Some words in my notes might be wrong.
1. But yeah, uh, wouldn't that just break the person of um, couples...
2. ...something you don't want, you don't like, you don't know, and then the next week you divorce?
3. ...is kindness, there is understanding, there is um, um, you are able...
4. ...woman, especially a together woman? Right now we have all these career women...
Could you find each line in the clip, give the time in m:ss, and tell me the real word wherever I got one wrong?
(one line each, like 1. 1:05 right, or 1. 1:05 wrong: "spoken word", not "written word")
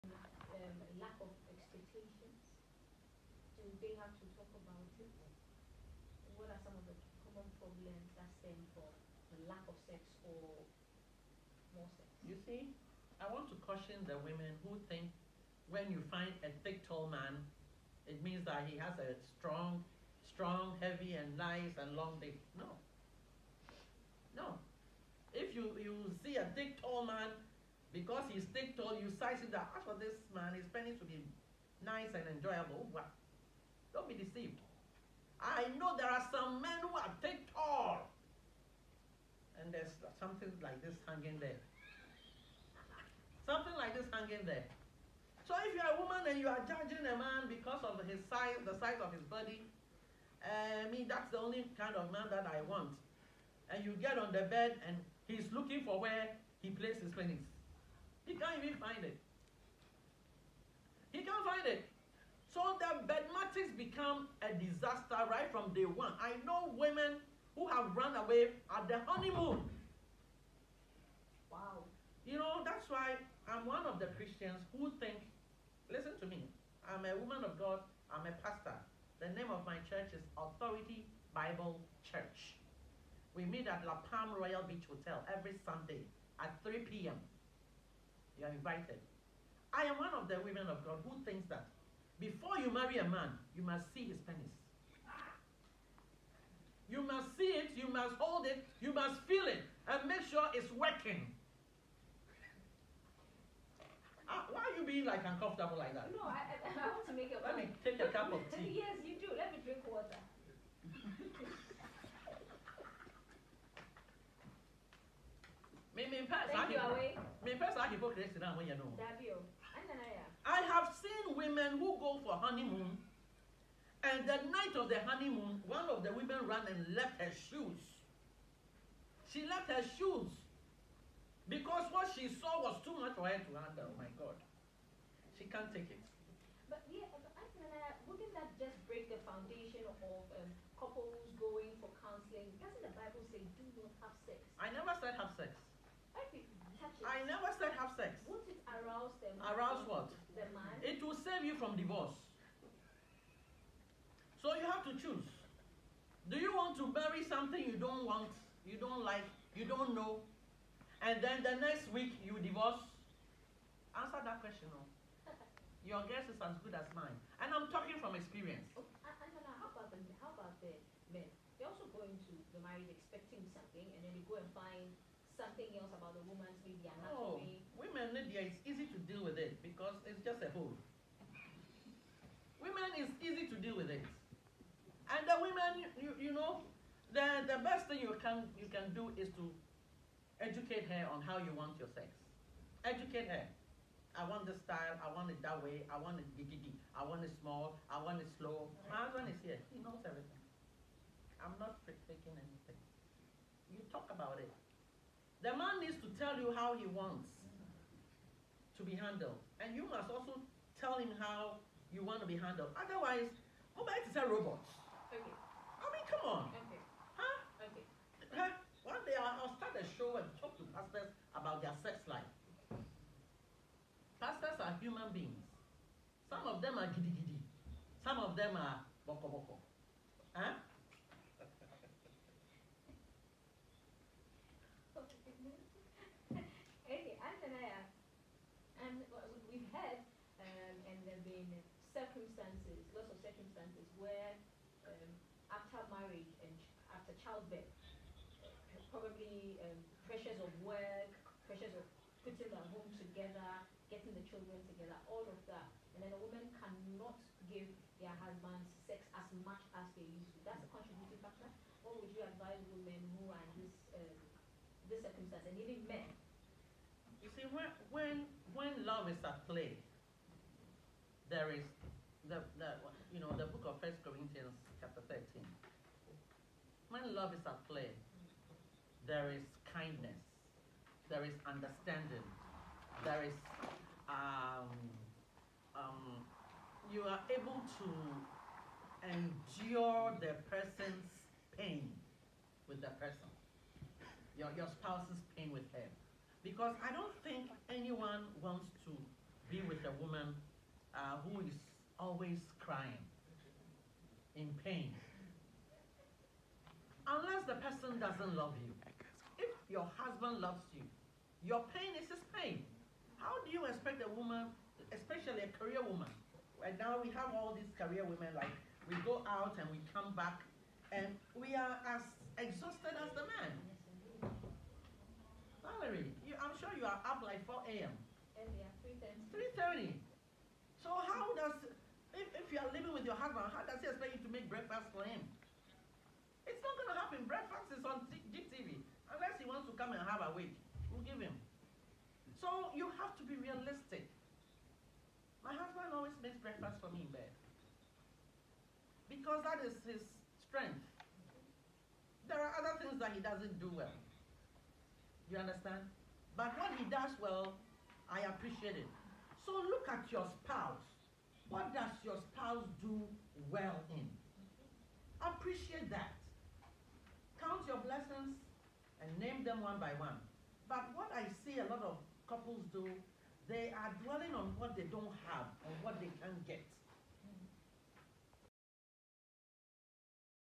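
1. 2:16 wrong: "foundation", not "person"
2. 2:37 right
3. 4:39 right
4. 5:14 wrong: "career", not "together".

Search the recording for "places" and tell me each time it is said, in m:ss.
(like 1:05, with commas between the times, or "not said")
0:56.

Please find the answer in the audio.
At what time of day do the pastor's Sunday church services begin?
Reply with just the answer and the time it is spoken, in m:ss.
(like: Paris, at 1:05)
3 p.m., at 1:26.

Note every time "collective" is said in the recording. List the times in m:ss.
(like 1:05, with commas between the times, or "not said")
not said.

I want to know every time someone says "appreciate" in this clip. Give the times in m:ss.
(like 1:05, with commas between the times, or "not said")
5:58, 6:05.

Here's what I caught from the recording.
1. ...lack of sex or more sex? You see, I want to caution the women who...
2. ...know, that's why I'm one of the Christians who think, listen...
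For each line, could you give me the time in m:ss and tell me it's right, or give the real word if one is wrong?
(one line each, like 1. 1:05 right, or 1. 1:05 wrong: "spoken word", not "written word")
1. 0:09 right
2. 1:12 right.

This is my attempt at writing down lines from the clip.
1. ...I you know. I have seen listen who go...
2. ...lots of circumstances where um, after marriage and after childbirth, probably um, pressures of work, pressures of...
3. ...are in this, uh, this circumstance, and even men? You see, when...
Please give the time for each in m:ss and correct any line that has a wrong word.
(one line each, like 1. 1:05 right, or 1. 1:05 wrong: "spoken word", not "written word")
1. 1:56 wrong: "women", not "listen"
2. 4:02 right
3. 4:23 right.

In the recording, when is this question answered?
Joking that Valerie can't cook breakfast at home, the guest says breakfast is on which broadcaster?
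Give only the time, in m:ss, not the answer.
5:38.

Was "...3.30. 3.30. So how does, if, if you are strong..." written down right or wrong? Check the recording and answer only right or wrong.
wrong.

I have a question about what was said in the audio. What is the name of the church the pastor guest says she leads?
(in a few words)
Authority Bible Church.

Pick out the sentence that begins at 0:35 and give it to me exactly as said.
I know there are some men who are thick tall.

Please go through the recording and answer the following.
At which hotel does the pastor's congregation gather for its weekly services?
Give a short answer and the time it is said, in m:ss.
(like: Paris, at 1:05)
La Palm Royal Beach Hotel, at 1:23.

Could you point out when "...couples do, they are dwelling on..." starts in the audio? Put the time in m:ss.
6:12.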